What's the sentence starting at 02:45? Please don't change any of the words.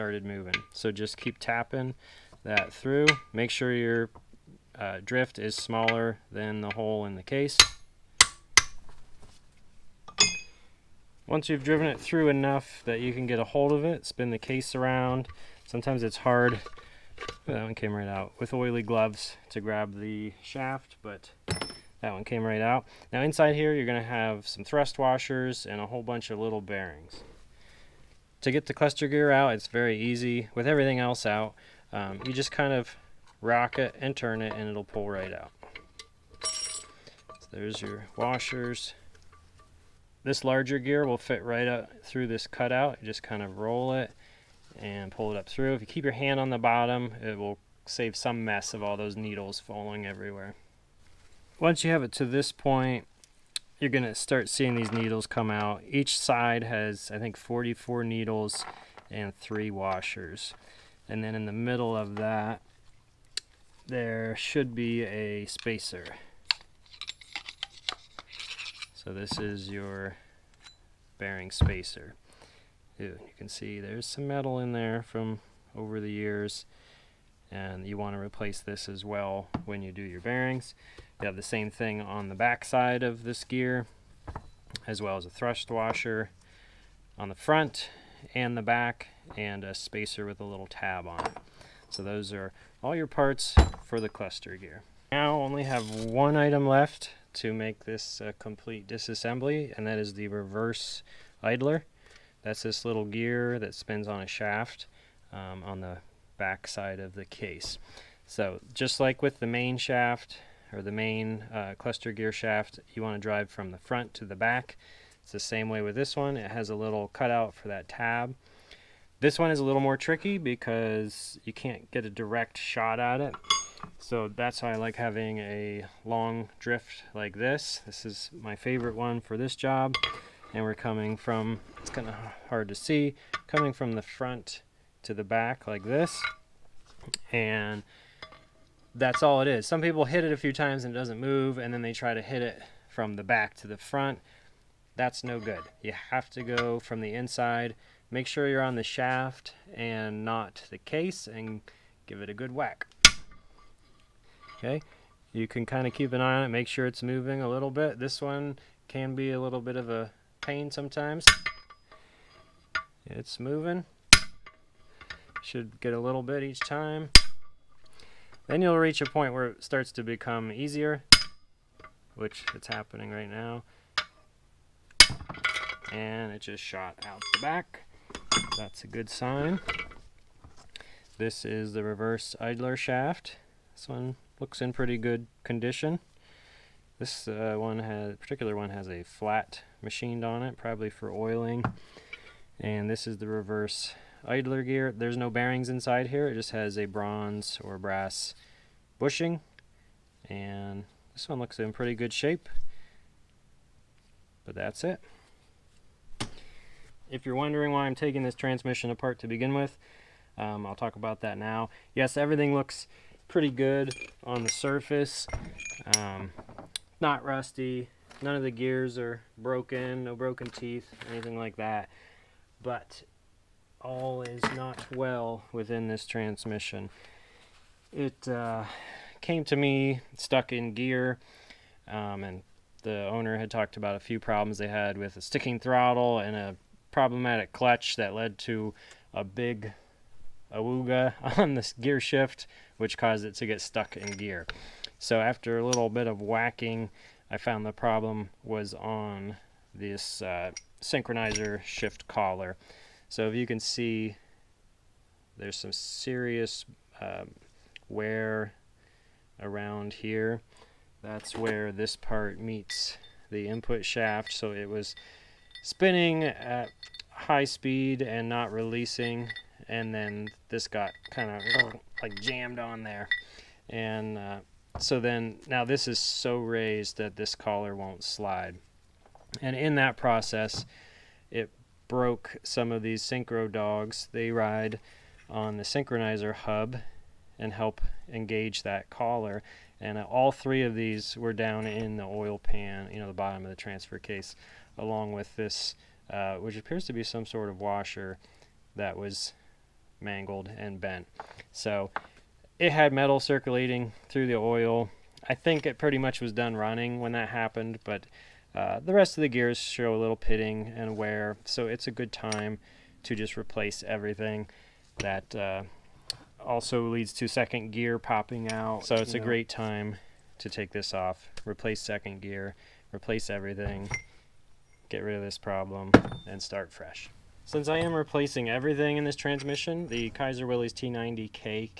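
Should get a little bit each time.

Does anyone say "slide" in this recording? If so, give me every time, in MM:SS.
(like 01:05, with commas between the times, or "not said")
04:38.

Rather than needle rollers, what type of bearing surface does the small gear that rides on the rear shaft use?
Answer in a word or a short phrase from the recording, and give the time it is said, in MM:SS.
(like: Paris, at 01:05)
bronze or brass bushing, at 03:16.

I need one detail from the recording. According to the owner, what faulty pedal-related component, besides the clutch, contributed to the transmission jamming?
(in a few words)
sticking throttle.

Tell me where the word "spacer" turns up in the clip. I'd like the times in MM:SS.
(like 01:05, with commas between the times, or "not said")
01:05, 01:11, 01:29.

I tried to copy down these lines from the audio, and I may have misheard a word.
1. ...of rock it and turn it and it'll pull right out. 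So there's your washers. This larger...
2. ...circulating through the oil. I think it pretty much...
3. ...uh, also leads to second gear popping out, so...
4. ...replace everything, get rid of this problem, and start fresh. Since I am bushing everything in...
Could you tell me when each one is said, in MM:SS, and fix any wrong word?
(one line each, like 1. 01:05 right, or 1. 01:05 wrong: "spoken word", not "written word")
1. 00:32 right
2. 05:03 right
3. 05:15 right
4. 05:22 wrong: "replacing", not "bushing".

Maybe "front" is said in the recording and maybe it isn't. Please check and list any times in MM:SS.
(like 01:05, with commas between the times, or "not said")
01:27, 01:53, 02:14, 02:23.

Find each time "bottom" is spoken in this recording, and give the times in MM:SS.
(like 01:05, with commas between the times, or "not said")
00:46, 04:53.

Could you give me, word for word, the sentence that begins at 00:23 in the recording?
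Now inside here, you're gonna have some thrust washers and a whole bunch of little bearings.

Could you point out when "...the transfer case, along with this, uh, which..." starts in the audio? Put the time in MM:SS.
04:53.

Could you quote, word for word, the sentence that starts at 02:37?
This one can be a little bit of a pain sometimes.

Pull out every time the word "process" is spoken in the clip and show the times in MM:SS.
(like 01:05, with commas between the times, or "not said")
04:39.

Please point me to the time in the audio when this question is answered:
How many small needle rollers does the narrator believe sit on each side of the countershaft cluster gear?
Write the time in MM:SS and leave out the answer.
00:57.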